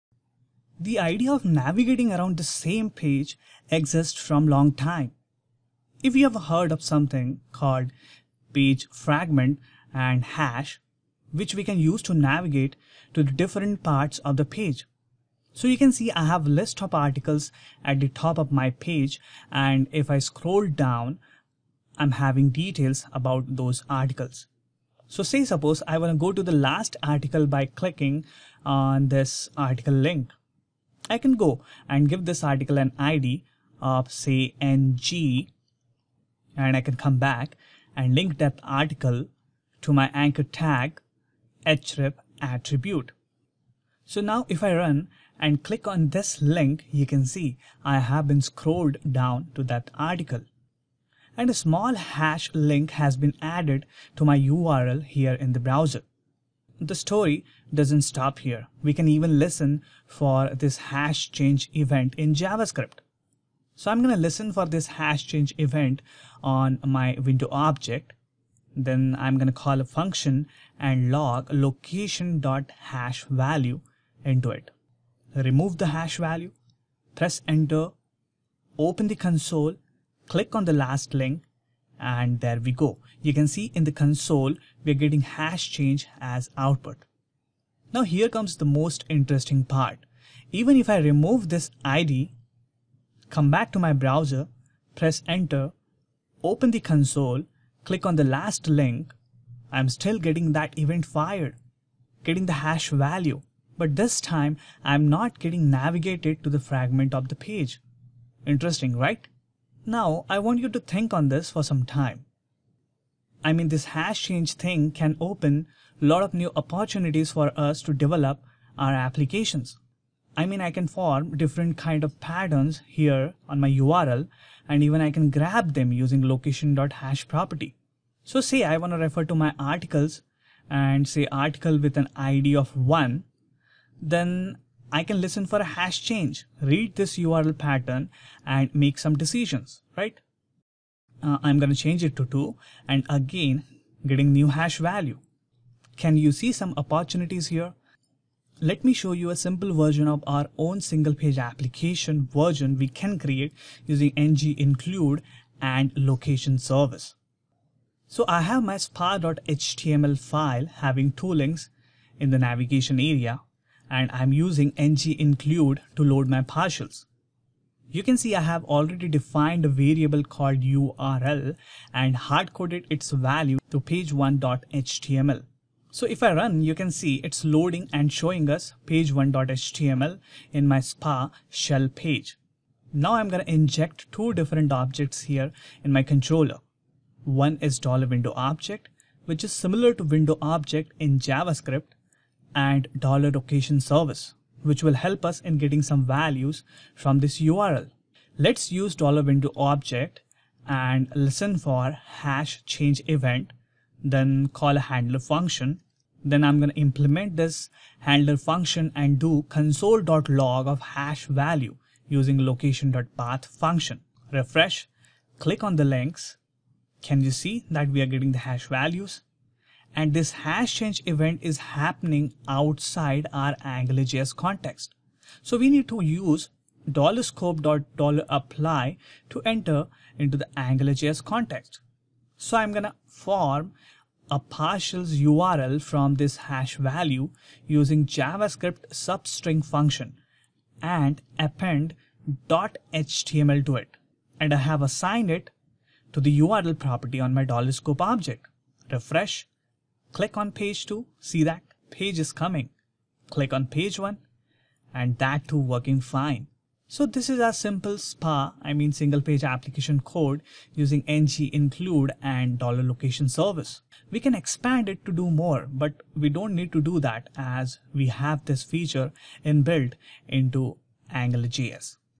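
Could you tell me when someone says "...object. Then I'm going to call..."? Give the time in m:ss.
1:07.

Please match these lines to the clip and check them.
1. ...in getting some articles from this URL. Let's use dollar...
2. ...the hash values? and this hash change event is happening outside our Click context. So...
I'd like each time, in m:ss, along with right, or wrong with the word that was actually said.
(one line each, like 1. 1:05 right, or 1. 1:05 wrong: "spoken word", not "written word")
1. 3:15 wrong: "values", not "articles"
2. 3:38 wrong: "AngularJS", not "Click".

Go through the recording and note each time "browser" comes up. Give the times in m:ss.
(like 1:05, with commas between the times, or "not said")
0:55, 1:33.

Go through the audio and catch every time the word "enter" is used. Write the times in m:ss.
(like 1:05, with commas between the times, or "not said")
1:17, 1:35, 3:49.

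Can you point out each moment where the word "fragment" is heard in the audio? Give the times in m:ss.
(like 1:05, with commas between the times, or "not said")
0:08, 1:46.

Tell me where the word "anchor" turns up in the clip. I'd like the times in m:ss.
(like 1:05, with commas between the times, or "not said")
0:40.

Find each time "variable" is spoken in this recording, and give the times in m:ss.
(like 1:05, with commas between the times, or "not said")
2:49.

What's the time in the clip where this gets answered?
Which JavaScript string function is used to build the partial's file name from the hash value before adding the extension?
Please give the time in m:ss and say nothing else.
3:58.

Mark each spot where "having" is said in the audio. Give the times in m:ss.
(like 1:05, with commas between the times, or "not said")
0:22, 2:40.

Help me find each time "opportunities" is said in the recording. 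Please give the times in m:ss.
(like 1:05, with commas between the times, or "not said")
1:56, 2:26.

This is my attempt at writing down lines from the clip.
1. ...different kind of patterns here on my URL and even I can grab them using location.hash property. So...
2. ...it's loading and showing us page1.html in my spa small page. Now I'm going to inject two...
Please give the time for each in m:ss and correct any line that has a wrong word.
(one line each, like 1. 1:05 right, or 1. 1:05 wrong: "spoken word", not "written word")
1. 2:01 right
2. 2:57 wrong: "shell", not "small".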